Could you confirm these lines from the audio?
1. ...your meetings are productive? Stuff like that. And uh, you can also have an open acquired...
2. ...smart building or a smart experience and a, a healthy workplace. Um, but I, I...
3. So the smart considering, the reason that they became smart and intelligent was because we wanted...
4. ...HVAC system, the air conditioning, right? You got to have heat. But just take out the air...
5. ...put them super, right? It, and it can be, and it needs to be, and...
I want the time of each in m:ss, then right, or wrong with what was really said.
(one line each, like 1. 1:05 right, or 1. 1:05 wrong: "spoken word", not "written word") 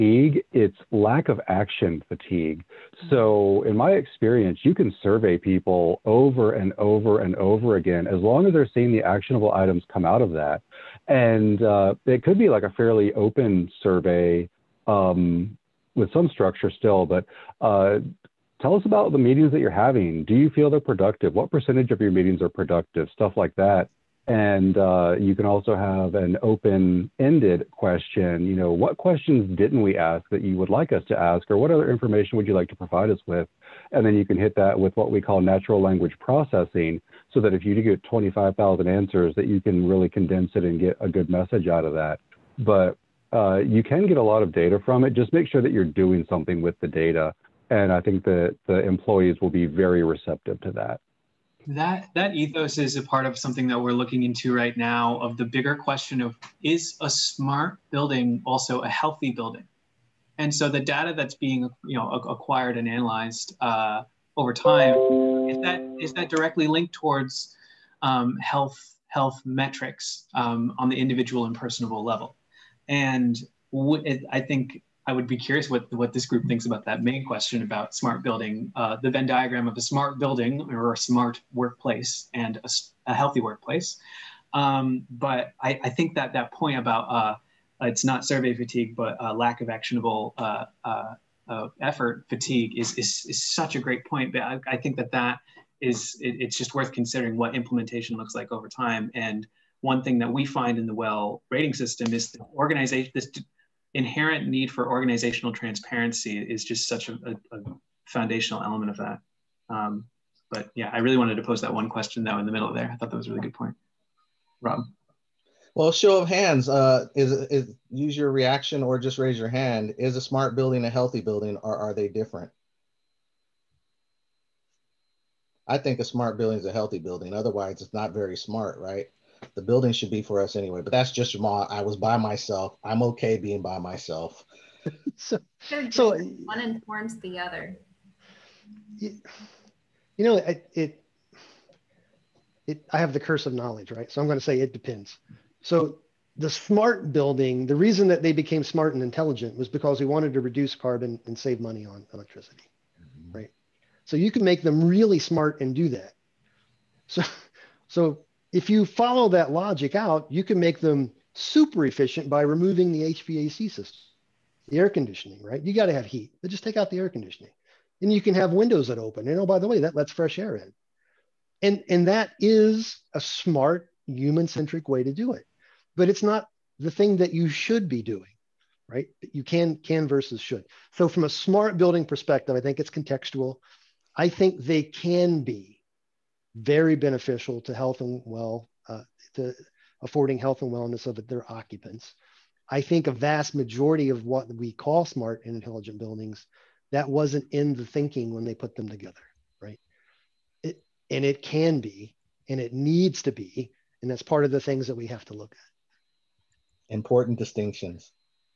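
1. 0:22 wrong: "ended", not "acquired"
2. 1:19 wrong: "workplace", not "experience"
3. 2:25 wrong: "building", not "considering"
4. 2:43 right
5. 3:18 wrong: "together", not "super".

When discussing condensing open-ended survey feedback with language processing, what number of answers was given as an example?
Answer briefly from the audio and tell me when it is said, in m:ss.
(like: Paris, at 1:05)
25,000, at 0:38.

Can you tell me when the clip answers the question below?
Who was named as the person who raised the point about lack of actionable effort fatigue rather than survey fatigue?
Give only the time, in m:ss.
1:54.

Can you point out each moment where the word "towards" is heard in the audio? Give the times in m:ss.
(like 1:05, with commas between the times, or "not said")
1:06.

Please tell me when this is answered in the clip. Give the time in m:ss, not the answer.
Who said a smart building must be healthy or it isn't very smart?
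2:11.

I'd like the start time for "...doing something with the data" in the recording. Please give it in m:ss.
0:45.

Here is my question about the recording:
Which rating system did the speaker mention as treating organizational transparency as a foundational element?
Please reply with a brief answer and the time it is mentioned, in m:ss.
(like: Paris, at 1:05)
WELL rating system, at 1:40.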